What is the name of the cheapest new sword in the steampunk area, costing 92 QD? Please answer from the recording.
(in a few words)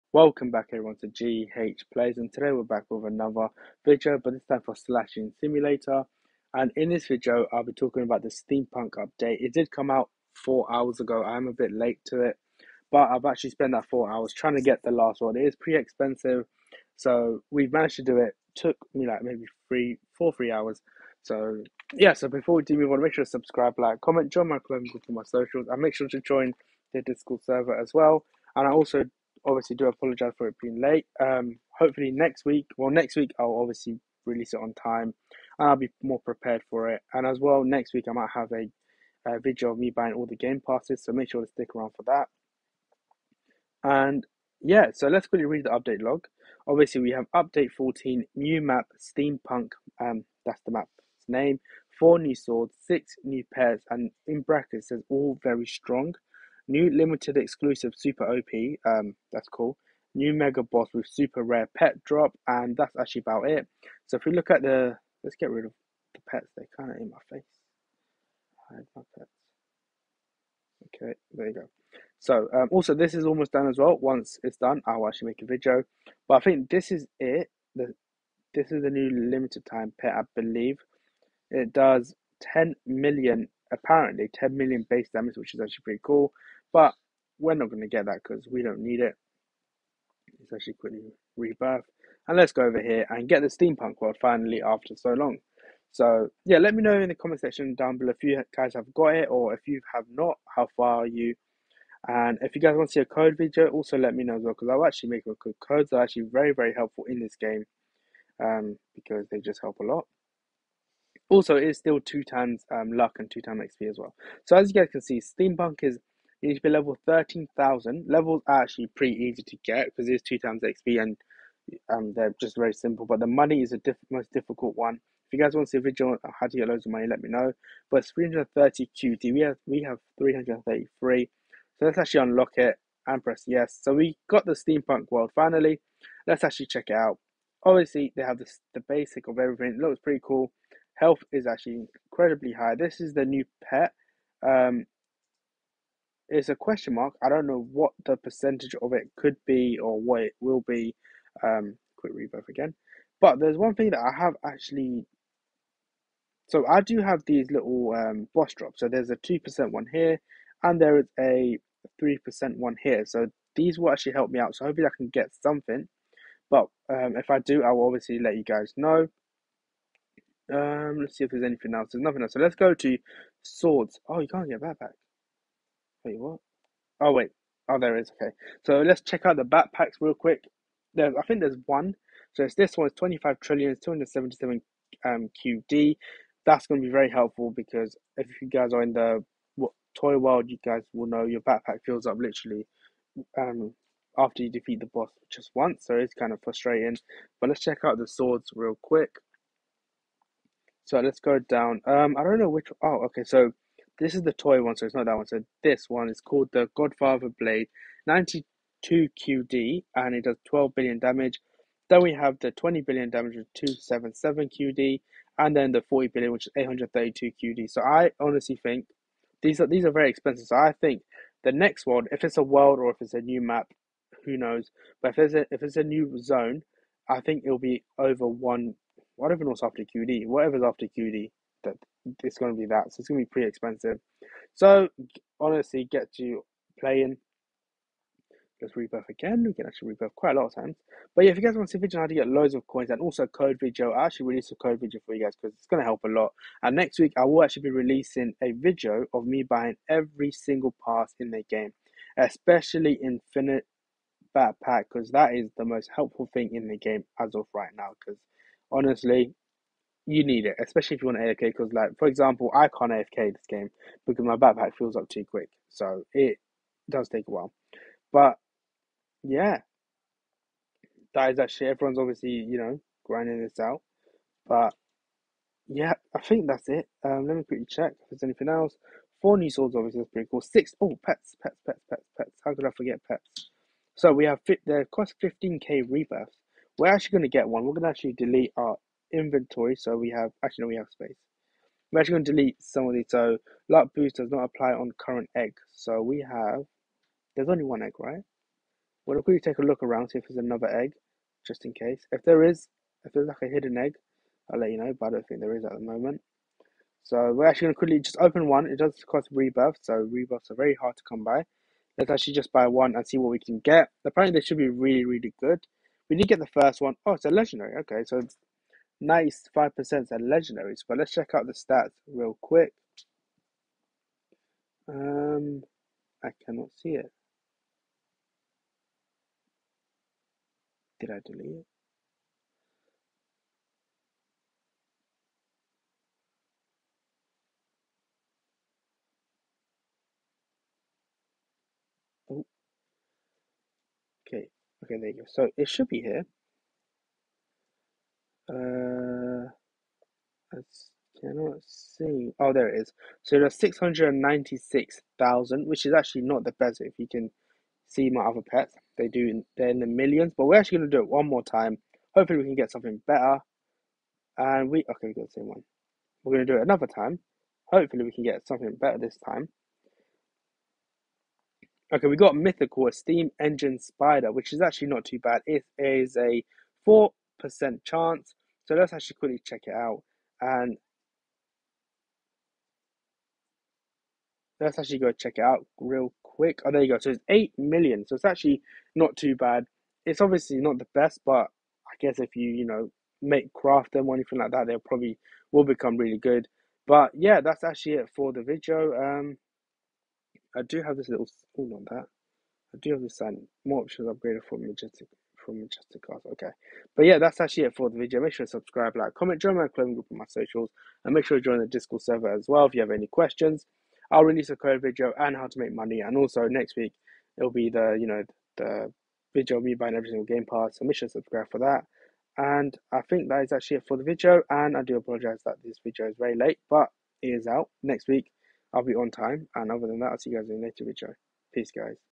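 Godfather Blade.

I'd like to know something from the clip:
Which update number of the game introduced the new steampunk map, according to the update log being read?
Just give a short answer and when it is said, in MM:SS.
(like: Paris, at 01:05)
14, at 00:47.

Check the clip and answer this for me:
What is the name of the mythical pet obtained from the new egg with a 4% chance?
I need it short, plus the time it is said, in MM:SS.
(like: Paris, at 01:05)
steam engine spider, at 06:12.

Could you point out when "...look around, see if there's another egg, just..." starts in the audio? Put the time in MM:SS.
04:59.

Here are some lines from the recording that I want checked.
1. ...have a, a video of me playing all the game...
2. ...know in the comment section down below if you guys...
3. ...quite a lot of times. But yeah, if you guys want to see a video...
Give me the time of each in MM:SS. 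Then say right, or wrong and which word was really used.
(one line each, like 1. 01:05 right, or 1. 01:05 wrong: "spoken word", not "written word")
1. 00:38 wrong: "buying", not "playing"
2. 01:36 right
3. 04:00 right.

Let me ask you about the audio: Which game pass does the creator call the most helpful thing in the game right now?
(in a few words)
Infinite Backpack.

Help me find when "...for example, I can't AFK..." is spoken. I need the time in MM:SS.
04:21.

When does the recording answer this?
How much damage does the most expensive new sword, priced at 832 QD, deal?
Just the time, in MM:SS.
03:35.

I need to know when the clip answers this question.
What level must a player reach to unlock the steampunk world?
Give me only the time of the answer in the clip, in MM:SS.
01:56.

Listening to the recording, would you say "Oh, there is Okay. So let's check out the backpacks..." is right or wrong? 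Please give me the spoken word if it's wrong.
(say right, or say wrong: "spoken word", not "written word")
right.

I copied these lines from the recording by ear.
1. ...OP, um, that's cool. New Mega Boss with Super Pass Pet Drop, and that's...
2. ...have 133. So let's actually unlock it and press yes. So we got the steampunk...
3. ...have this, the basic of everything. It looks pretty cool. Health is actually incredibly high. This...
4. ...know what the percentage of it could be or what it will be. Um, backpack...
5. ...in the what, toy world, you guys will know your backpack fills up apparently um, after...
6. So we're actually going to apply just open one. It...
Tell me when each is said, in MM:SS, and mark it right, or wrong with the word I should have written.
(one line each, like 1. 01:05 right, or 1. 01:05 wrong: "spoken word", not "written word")
1. 00:58 wrong: "Rare", not "Pass"
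2. 02:09 wrong: "333", not "133"
3. 02:18 right
4. 02:27 wrong: "quick", not "backpack"
5. 03:08 wrong: "literally", not "apparently"
6. 05:07 wrong: "quickly", not "apply".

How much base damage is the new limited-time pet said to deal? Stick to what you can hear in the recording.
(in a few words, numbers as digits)
10 million.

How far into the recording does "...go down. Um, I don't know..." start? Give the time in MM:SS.
03:21.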